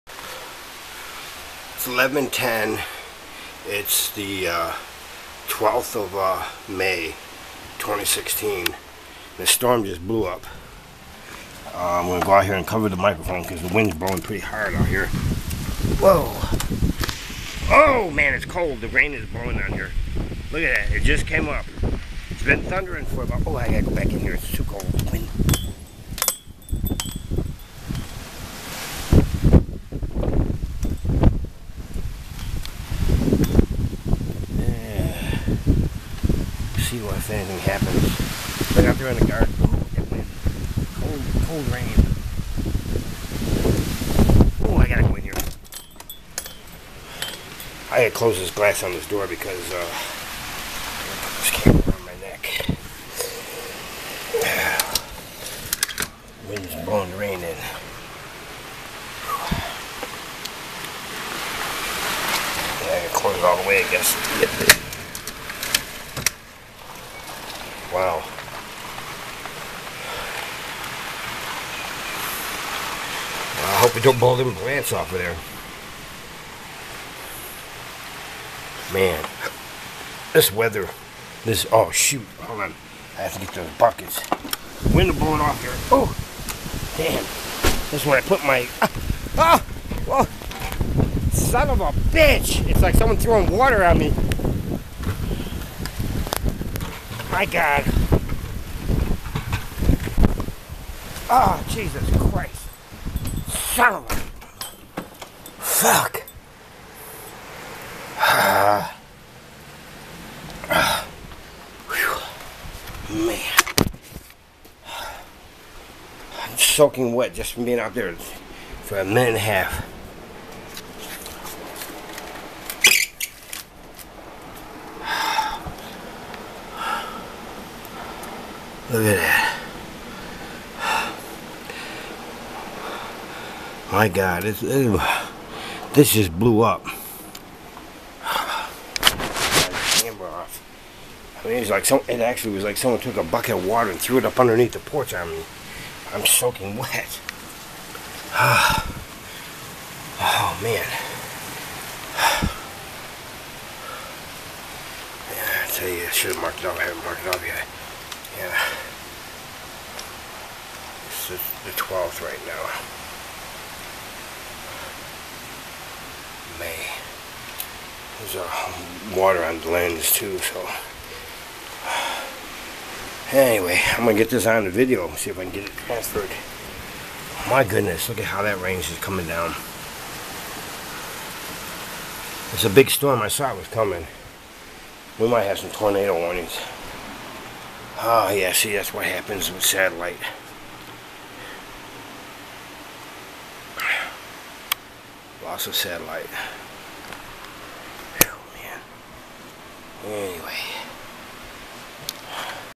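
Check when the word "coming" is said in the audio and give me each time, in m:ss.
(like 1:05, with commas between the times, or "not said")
2:58, 3:03.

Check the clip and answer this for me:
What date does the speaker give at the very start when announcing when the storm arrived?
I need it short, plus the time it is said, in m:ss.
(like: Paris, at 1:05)
12th of May, 2016, at 0:05.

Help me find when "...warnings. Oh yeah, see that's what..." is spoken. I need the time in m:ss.
3:06.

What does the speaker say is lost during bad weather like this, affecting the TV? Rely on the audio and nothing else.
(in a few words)
Loss of satellite.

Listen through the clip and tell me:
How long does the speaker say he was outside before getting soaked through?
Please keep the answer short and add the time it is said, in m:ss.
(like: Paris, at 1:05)
A minute and a half, at 1:58.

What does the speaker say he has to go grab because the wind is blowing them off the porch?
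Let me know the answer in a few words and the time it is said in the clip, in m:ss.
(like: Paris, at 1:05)
Buckets, at 1:23.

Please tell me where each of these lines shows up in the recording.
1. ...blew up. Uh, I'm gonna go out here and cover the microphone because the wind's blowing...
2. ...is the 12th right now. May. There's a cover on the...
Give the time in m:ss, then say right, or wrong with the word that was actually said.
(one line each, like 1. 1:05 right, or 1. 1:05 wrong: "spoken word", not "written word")
1. 0:10 right
2. 2:41 wrong: "water", not "cover".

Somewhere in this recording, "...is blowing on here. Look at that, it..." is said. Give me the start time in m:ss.
0:19.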